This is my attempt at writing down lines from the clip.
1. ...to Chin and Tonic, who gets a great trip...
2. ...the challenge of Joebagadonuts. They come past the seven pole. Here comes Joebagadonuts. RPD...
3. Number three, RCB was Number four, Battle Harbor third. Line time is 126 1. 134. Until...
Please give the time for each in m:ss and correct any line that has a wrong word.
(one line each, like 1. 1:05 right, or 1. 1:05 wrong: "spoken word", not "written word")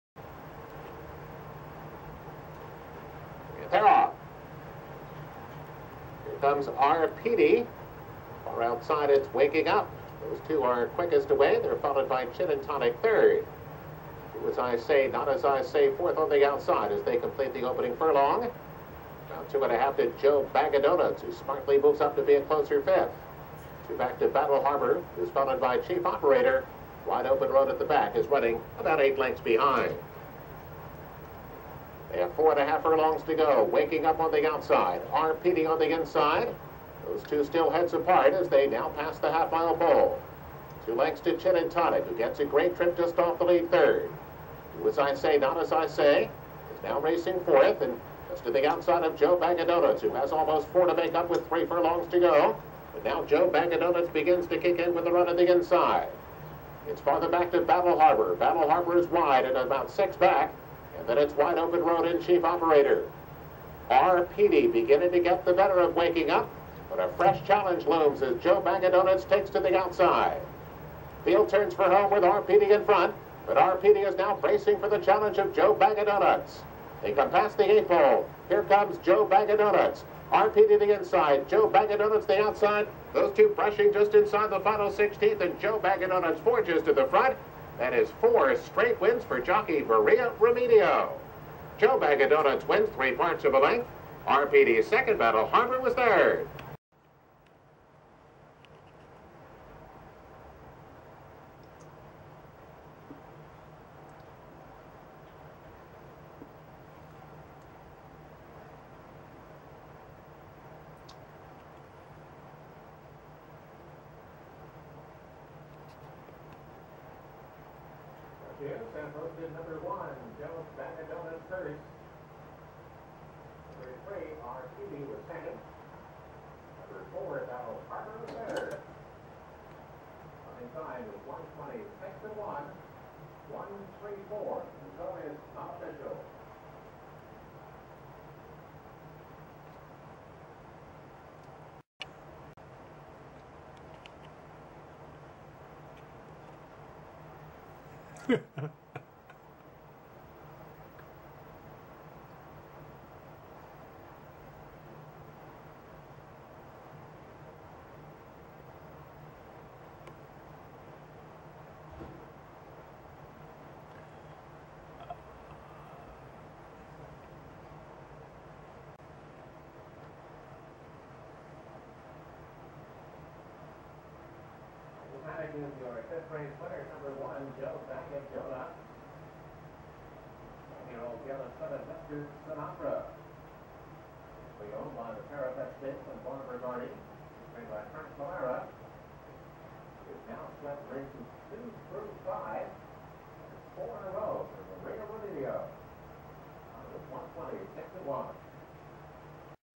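1. 0:41 right
2. 1:14 wrong: "eight", not "seven"
3. 2:03 right.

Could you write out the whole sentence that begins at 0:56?
It's farther back to Battle Harbor.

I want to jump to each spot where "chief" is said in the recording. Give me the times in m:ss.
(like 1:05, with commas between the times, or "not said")
0:25, 1:02.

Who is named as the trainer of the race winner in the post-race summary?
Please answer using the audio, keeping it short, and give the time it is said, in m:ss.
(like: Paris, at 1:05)
Frank Pollara, at 3:07.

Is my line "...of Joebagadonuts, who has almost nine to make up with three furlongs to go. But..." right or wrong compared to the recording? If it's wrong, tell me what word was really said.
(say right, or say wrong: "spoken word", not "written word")
wrong: "four", not "nine".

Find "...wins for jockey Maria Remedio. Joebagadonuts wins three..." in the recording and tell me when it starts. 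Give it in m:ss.
1:28.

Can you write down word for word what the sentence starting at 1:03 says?
RPD beginning to get the better of waking up, but a fresh challenge looms as Joebagadonuts takes to the outside.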